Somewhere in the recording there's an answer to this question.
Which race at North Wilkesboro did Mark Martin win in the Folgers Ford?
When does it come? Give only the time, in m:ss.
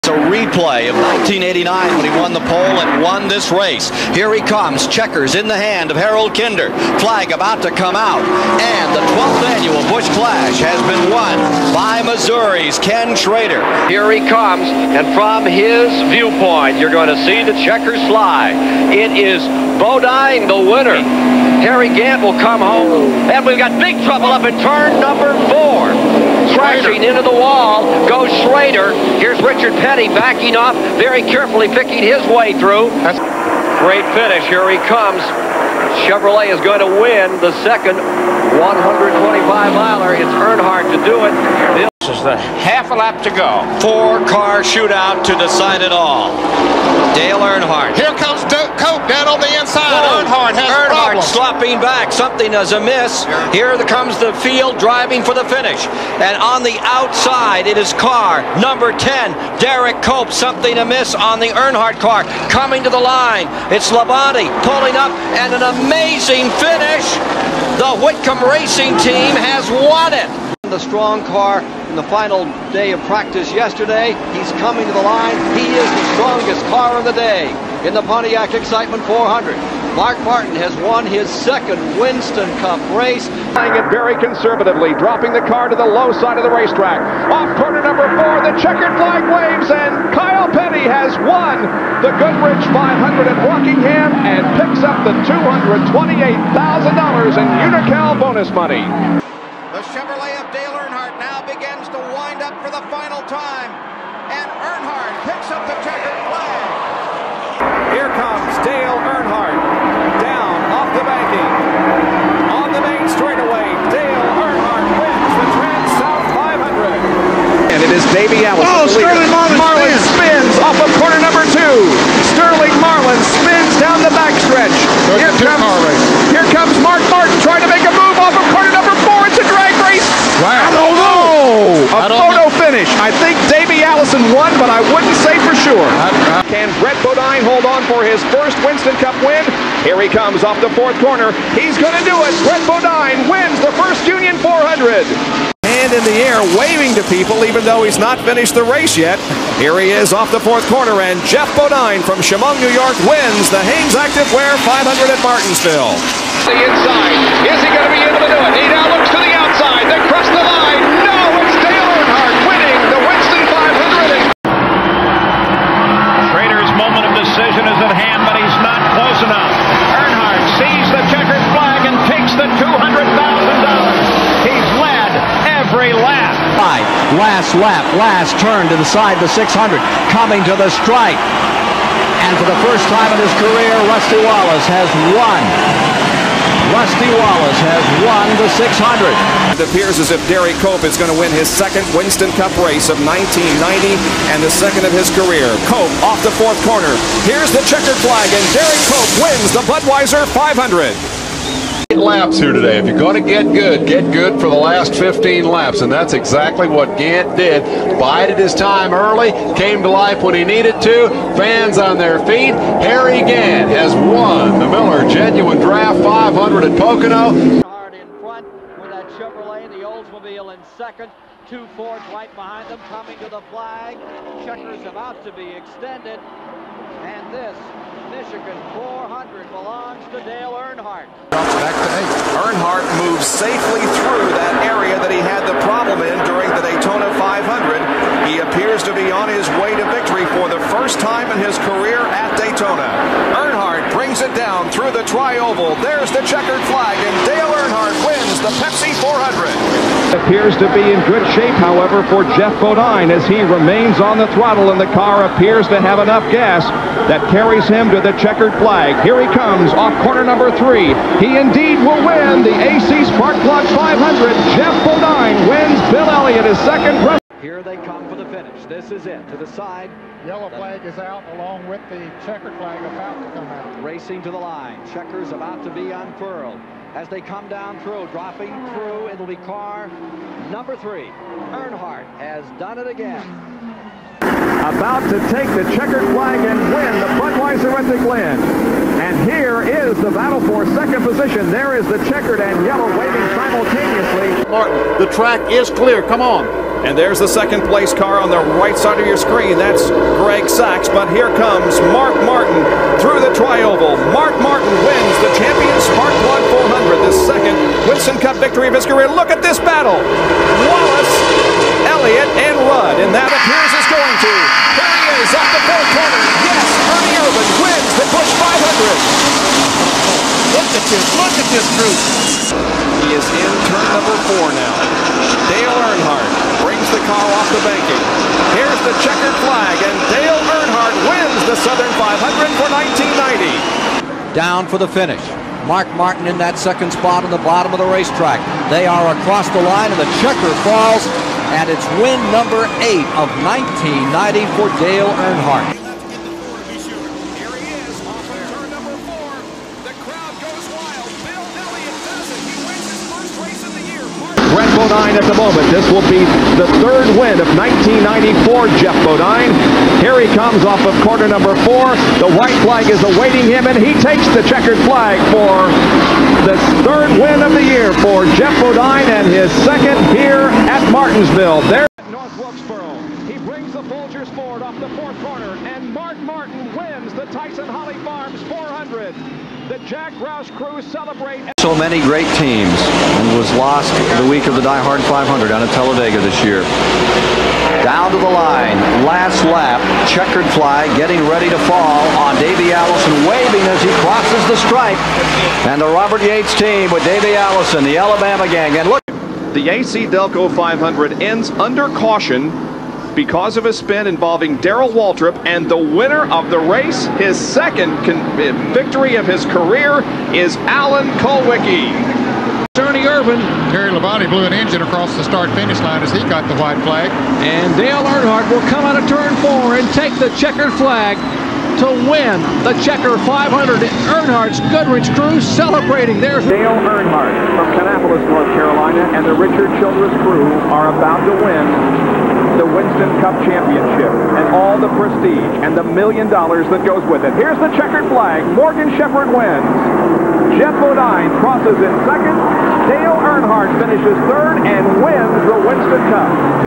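6:17.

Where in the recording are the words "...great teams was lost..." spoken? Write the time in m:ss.
6:22.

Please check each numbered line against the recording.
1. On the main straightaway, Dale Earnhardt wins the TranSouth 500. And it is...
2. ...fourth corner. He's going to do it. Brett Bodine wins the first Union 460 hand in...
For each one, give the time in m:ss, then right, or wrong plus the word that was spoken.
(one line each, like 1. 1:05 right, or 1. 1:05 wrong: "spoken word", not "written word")
1. 1:52 right
2. 2:20 wrong: "400", not "460".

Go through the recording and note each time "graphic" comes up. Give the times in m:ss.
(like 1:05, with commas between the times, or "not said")
not said.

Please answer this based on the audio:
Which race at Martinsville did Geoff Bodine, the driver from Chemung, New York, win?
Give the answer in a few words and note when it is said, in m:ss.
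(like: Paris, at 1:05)
Hanes Active Wear 500, at 2:33.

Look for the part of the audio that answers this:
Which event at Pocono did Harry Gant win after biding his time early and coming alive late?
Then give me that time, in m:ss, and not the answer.
3:34.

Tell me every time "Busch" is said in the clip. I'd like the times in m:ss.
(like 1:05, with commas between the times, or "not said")
0:09, 5:18.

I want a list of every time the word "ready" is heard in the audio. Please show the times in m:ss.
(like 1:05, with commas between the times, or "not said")
6:31.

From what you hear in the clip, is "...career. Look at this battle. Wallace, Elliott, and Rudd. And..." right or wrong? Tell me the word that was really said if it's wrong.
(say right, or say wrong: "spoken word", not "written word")
right.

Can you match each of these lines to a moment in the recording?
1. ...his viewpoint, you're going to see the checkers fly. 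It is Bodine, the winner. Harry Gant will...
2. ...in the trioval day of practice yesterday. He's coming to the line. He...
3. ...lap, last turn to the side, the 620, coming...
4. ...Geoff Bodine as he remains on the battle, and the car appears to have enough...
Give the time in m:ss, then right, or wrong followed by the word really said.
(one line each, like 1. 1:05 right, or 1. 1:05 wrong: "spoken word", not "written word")
1. 0:15 right
2. 1:11 wrong: "final", not "trioval"
3. 2:57 wrong: "600", not "620"
4. 4:12 wrong: "throttle", not "battle".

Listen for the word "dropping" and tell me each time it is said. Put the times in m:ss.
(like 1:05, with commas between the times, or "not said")
1:24, 4:38.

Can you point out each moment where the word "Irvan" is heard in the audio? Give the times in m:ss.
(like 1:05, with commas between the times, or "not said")
5:17, 6:53.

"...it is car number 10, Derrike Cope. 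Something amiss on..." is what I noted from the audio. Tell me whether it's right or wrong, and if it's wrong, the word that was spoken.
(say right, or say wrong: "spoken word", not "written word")
right.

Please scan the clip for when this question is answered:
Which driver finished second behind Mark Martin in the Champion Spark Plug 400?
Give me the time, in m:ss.
5:00.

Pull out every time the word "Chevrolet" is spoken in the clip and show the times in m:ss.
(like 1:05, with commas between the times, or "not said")
0:36, 3:39.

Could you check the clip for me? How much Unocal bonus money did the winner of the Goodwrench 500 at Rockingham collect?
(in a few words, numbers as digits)
$228,000.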